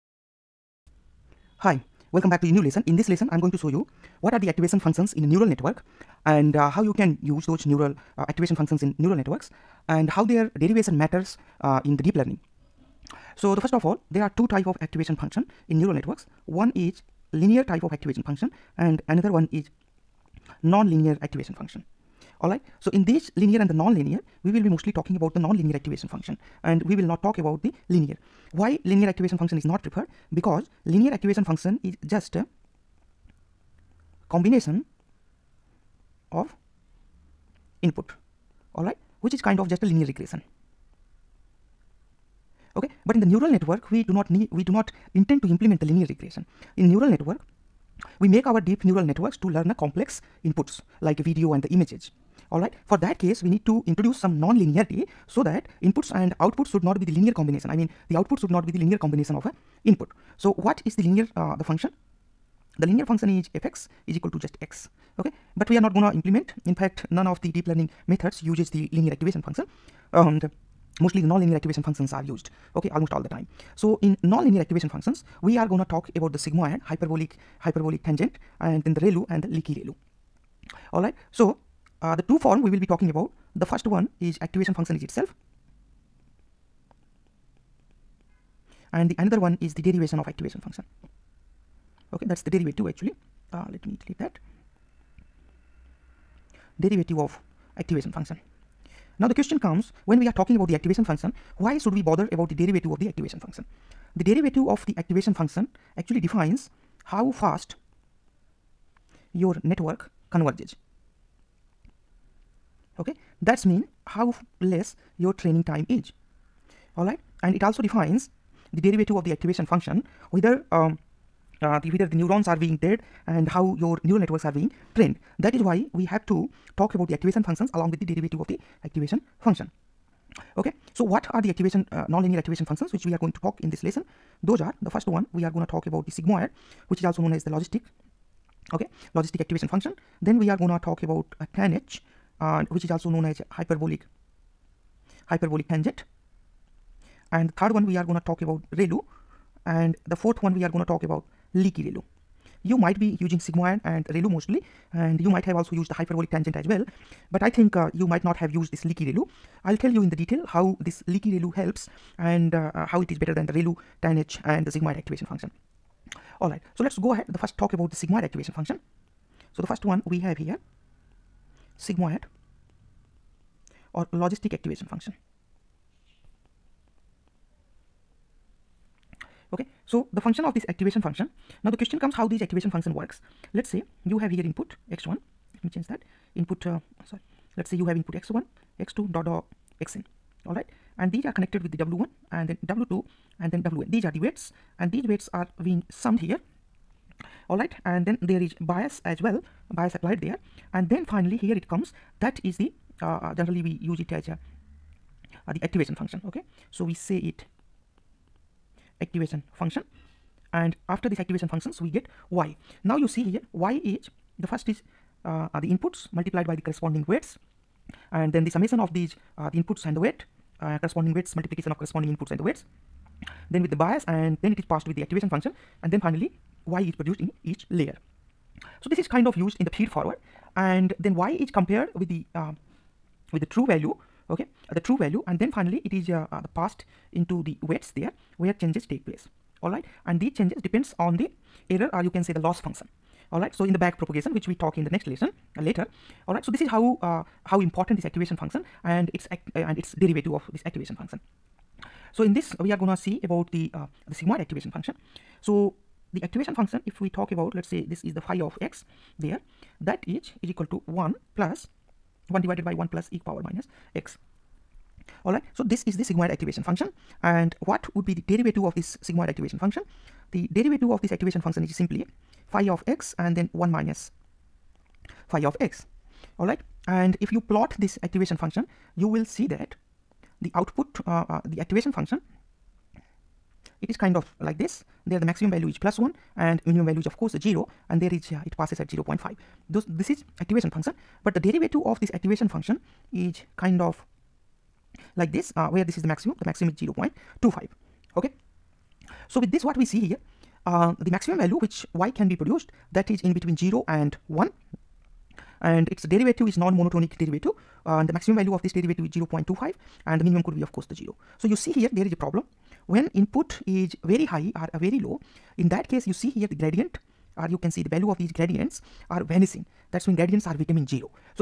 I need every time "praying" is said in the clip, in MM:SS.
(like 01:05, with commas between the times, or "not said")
not said.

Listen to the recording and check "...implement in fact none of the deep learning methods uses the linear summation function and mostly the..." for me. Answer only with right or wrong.
wrong.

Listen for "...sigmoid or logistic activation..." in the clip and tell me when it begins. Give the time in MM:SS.
02:51.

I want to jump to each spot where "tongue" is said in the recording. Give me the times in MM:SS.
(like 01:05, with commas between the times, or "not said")
not said.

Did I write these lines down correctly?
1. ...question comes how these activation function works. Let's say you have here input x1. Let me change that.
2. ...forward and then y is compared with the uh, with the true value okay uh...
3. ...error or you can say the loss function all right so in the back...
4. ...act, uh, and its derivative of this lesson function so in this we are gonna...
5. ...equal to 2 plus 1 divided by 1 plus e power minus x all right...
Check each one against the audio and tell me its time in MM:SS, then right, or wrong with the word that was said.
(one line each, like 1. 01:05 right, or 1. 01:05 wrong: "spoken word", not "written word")
1. 03:01 right
2. 03:49 right
3. 04:01 right
4. 04:09 wrong: "activation", not "lesson"
5. 04:20 wrong: "1", not "2".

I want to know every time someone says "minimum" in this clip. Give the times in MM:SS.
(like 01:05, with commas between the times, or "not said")
04:46, 05:10.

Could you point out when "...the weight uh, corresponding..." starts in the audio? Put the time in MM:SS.
03:39.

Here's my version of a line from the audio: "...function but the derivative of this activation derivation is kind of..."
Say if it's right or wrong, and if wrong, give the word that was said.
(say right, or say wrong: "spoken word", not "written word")
wrong: "function", not "derivation".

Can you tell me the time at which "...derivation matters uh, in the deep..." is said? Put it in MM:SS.
00:10.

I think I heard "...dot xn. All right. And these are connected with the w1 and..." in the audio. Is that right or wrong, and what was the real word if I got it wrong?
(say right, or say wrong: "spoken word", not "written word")
right.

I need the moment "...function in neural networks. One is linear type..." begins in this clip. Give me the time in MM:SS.
00:15.